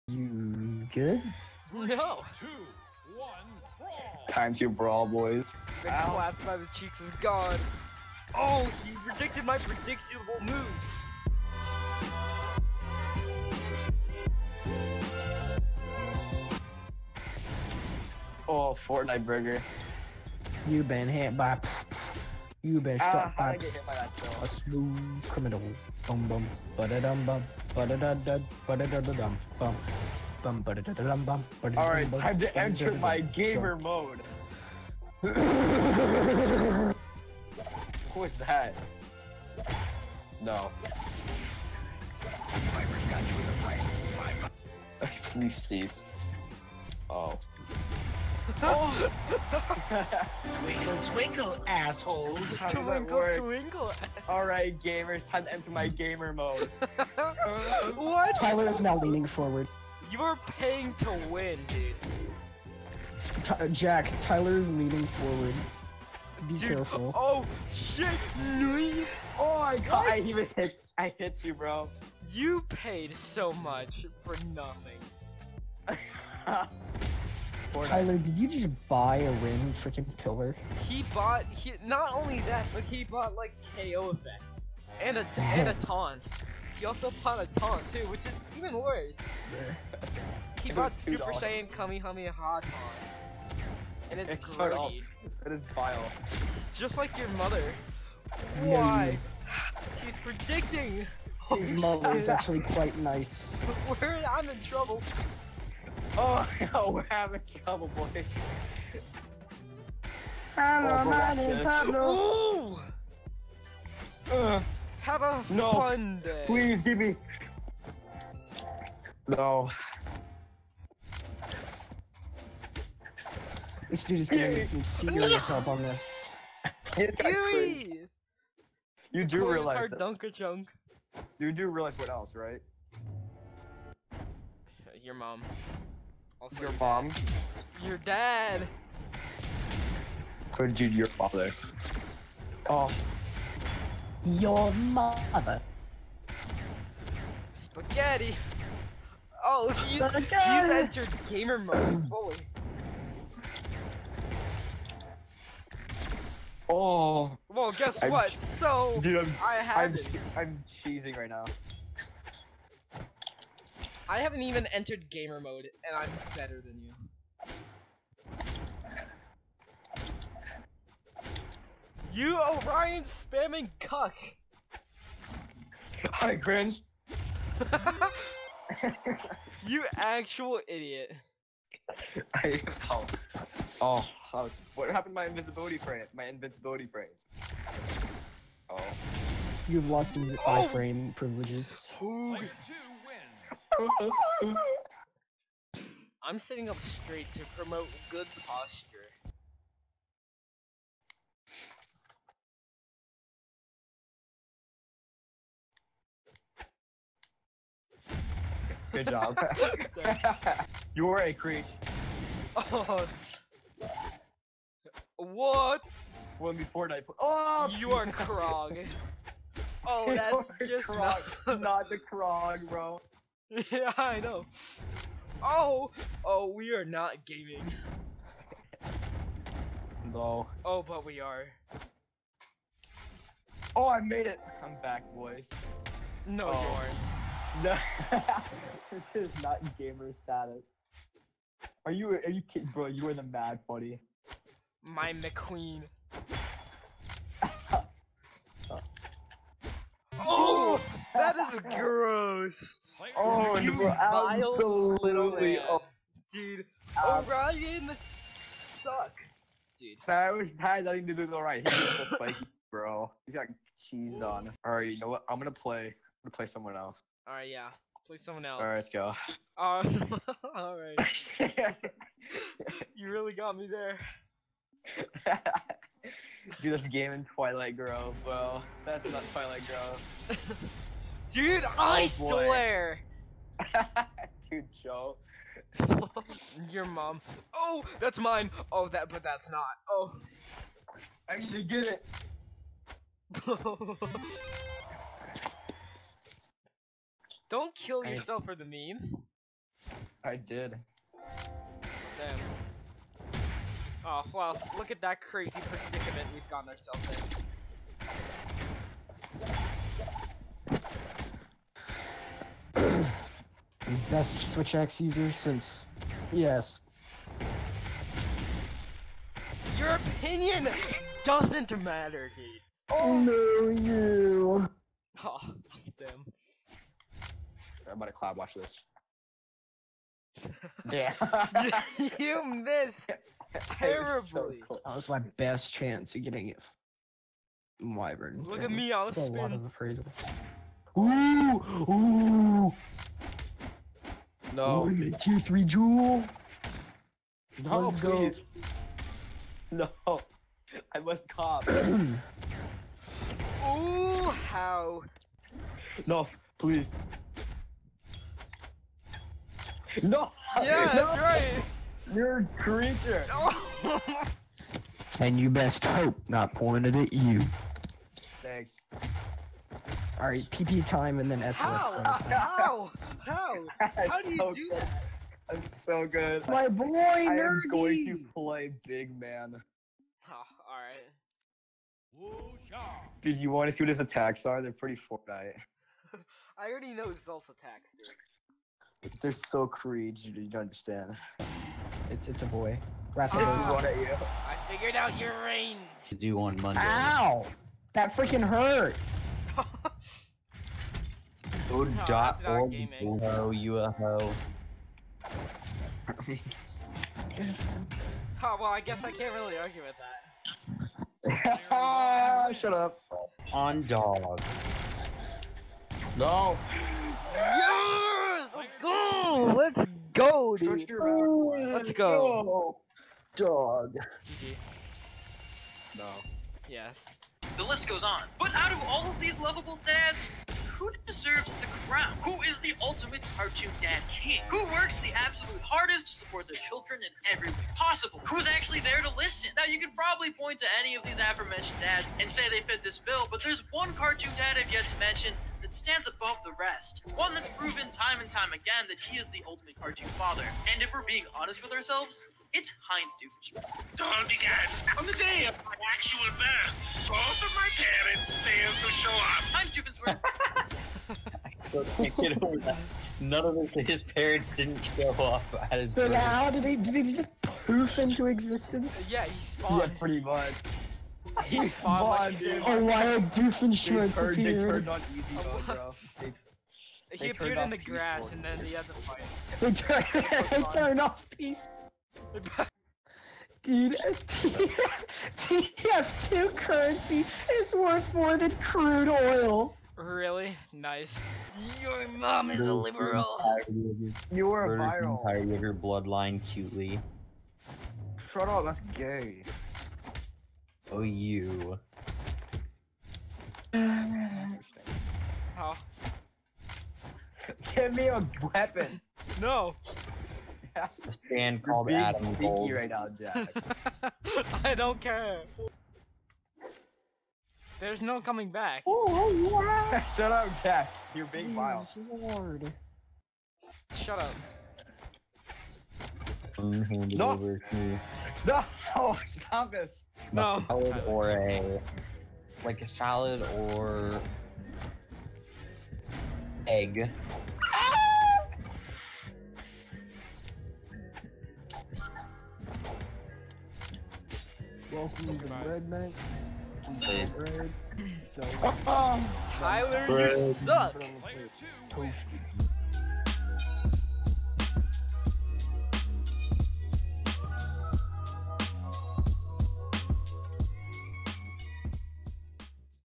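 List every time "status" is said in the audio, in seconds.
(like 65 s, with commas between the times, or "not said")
240 s.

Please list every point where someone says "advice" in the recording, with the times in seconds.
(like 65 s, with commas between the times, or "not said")
not said.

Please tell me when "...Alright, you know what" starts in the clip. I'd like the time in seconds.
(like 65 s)
264 s.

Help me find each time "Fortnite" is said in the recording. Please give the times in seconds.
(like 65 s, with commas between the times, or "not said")
18 s, 216 s, 385 s.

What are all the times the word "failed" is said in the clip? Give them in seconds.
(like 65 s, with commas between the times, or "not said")
458 s.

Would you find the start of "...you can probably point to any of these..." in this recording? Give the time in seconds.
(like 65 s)
439 s.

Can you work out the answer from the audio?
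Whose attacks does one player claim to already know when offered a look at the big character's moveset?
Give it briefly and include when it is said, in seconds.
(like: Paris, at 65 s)
Xull, at 387 s.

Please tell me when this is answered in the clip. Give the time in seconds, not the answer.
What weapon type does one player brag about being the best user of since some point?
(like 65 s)
314 s.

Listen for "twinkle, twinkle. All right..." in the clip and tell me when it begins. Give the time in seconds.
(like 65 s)
52 s.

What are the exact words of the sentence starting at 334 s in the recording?
So that was my best chance of getting it.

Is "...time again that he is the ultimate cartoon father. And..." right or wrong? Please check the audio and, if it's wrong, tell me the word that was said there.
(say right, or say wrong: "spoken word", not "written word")
right.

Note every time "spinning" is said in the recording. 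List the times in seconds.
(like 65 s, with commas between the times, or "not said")
339 s.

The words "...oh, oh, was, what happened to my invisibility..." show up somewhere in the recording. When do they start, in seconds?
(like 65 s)
182 s.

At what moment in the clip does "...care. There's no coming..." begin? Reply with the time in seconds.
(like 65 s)
514 s.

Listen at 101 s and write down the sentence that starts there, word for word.
His mother is actually quite nice.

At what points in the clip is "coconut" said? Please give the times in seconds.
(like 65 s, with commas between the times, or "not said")
not said.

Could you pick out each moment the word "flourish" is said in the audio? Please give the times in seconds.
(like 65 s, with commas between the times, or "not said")
not said.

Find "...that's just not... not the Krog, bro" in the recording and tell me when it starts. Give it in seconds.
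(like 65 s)
220 s.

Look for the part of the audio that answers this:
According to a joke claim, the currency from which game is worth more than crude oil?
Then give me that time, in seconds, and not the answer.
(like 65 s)
485 s.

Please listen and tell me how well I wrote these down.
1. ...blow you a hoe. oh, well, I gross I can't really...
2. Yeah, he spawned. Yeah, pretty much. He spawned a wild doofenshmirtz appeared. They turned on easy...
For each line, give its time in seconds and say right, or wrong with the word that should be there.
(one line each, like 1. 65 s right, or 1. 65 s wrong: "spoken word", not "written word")
1. 403 s wrong: "guess", not "gross"
2. 469 s right.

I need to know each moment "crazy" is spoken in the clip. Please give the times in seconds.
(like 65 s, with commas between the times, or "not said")
305 s.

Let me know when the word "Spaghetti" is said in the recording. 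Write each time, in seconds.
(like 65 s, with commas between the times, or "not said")
147 s.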